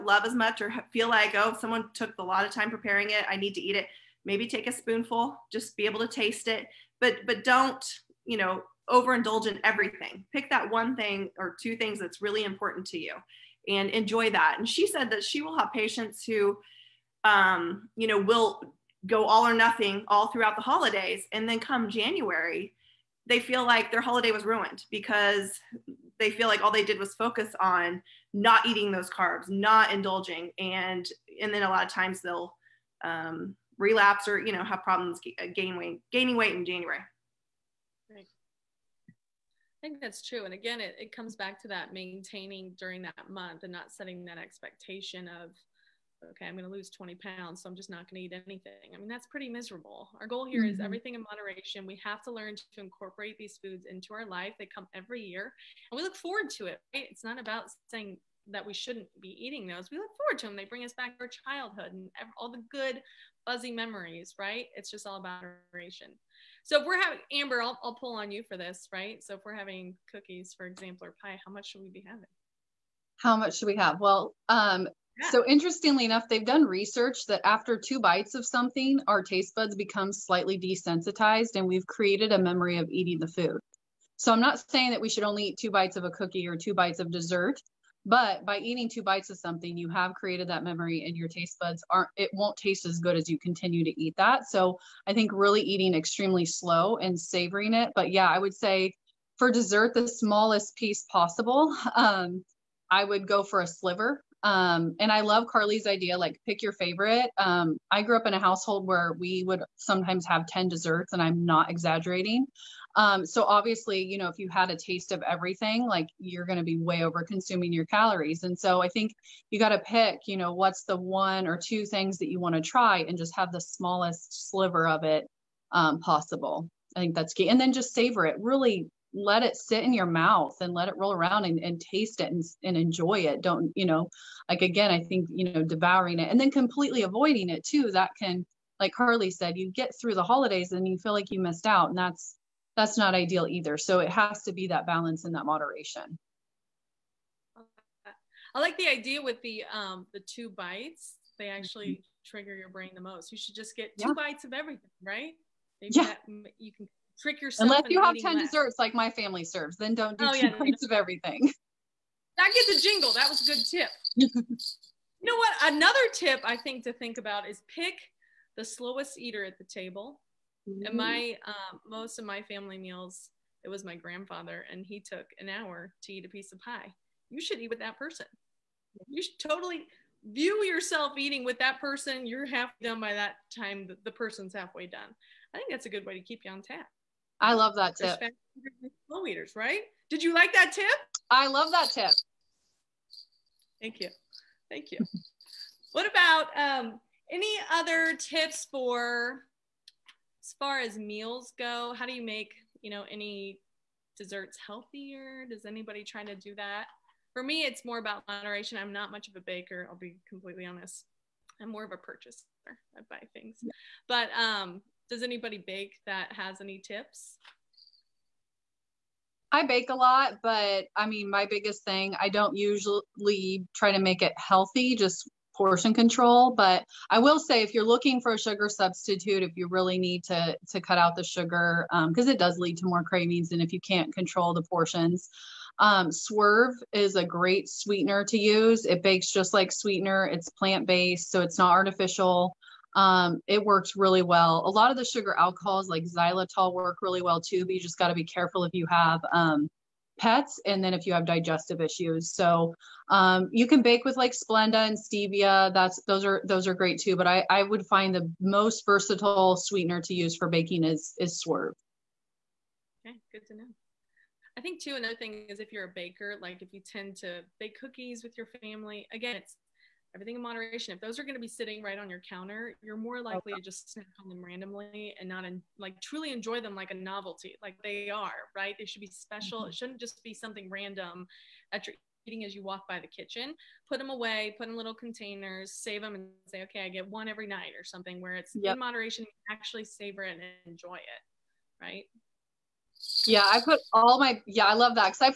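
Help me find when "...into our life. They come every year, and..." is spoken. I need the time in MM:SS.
00:53.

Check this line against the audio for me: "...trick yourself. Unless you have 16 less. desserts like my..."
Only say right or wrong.
wrong.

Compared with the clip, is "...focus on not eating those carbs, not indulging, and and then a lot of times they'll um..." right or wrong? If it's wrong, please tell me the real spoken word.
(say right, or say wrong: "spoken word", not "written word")
right.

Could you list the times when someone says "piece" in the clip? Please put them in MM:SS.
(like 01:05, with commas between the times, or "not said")
01:40, 02:56.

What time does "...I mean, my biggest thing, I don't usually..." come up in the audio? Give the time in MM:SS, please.
03:40.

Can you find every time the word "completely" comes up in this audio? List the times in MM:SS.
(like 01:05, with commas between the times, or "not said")
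02:16, 03:30.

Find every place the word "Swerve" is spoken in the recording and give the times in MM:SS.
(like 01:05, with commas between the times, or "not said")
03:56, 04:21.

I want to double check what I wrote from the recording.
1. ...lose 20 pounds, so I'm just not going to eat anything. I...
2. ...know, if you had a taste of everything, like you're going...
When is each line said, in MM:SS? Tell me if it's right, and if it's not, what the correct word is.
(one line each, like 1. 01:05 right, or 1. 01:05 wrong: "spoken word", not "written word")
1. 00:46 right
2. 01:54 right.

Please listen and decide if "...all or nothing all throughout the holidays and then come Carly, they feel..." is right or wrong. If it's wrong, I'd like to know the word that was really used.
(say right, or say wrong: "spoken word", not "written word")
wrong: "January", not "Carly".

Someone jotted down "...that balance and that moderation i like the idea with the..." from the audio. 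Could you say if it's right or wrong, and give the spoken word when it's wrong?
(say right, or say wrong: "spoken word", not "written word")
right.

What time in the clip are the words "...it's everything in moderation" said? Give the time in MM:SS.
04:29.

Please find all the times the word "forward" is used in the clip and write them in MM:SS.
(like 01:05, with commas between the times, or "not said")
00:56, 01:00.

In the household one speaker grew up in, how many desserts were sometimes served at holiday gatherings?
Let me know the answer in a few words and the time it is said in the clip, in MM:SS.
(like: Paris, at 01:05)
10, at 01:50.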